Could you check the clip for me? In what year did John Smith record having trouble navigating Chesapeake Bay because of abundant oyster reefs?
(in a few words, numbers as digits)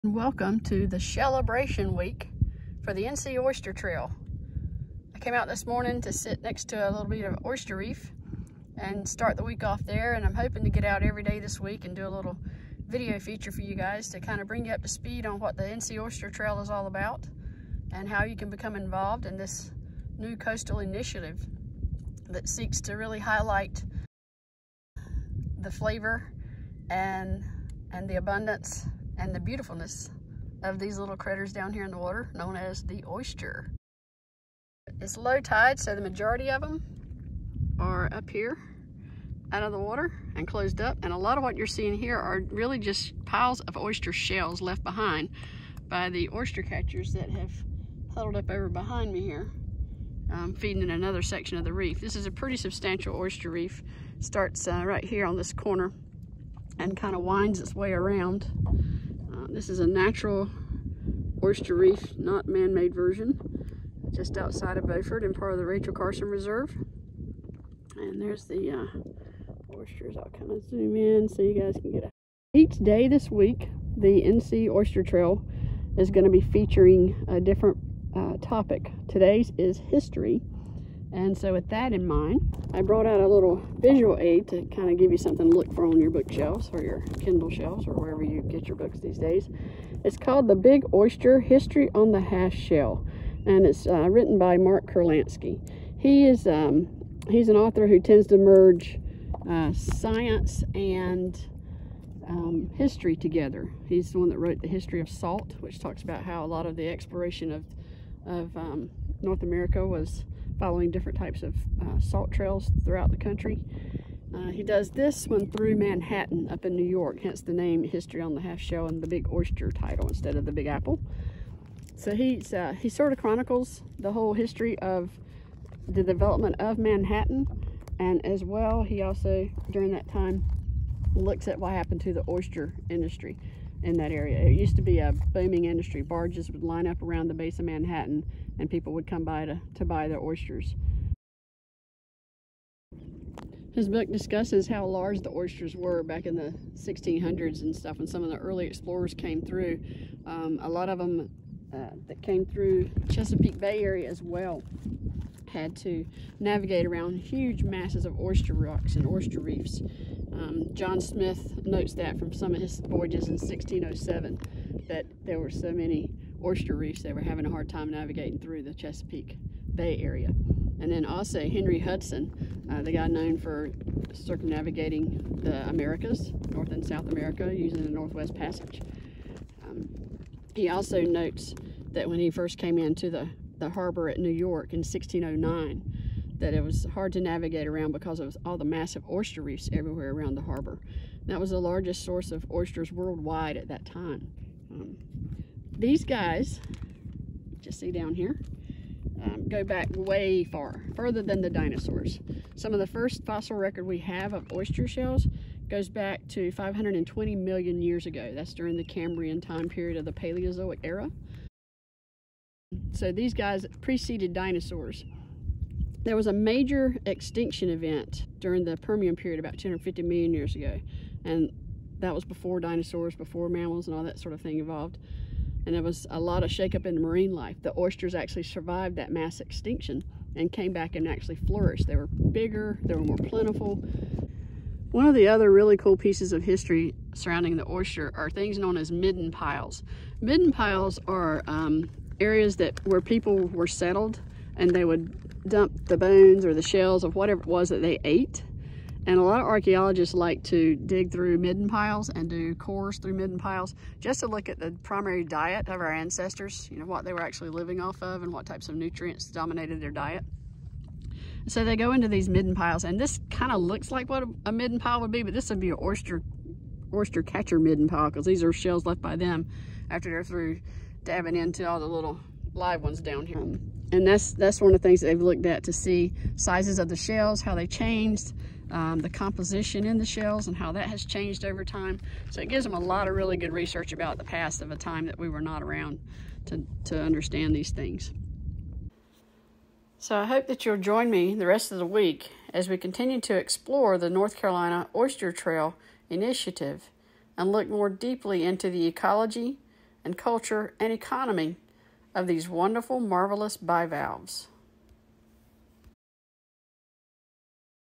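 1607.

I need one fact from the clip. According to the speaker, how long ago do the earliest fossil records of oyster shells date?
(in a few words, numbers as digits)
520 million years.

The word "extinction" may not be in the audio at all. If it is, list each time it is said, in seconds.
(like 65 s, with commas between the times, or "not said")
217 s, 229 s.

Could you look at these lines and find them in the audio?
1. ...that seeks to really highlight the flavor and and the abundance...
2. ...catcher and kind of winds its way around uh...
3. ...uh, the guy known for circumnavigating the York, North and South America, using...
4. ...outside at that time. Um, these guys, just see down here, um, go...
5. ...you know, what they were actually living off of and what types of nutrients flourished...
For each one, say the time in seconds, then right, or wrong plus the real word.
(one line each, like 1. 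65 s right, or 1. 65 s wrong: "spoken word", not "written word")
1. 22 s right
2. 55 s wrong: "corner", not "catcher"
3. 172 s wrong: "Americas", not "York"
4. 192 s wrong: "worldwide", not "outside"
5. 256 s wrong: "dominated", not "flourished".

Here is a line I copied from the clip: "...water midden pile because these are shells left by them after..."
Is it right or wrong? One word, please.
wrong.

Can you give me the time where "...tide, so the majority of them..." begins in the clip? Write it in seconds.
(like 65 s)
35 s.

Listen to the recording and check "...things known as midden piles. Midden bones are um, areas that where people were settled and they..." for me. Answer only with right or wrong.
wrong.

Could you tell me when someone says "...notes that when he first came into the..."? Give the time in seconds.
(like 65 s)
181 s.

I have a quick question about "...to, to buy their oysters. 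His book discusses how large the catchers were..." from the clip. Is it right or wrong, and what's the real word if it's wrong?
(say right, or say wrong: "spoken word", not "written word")
wrong: "oysters", not "catchers".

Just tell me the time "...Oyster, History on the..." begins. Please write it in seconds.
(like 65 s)
90 s.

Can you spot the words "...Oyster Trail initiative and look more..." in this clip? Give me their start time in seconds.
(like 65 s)
294 s.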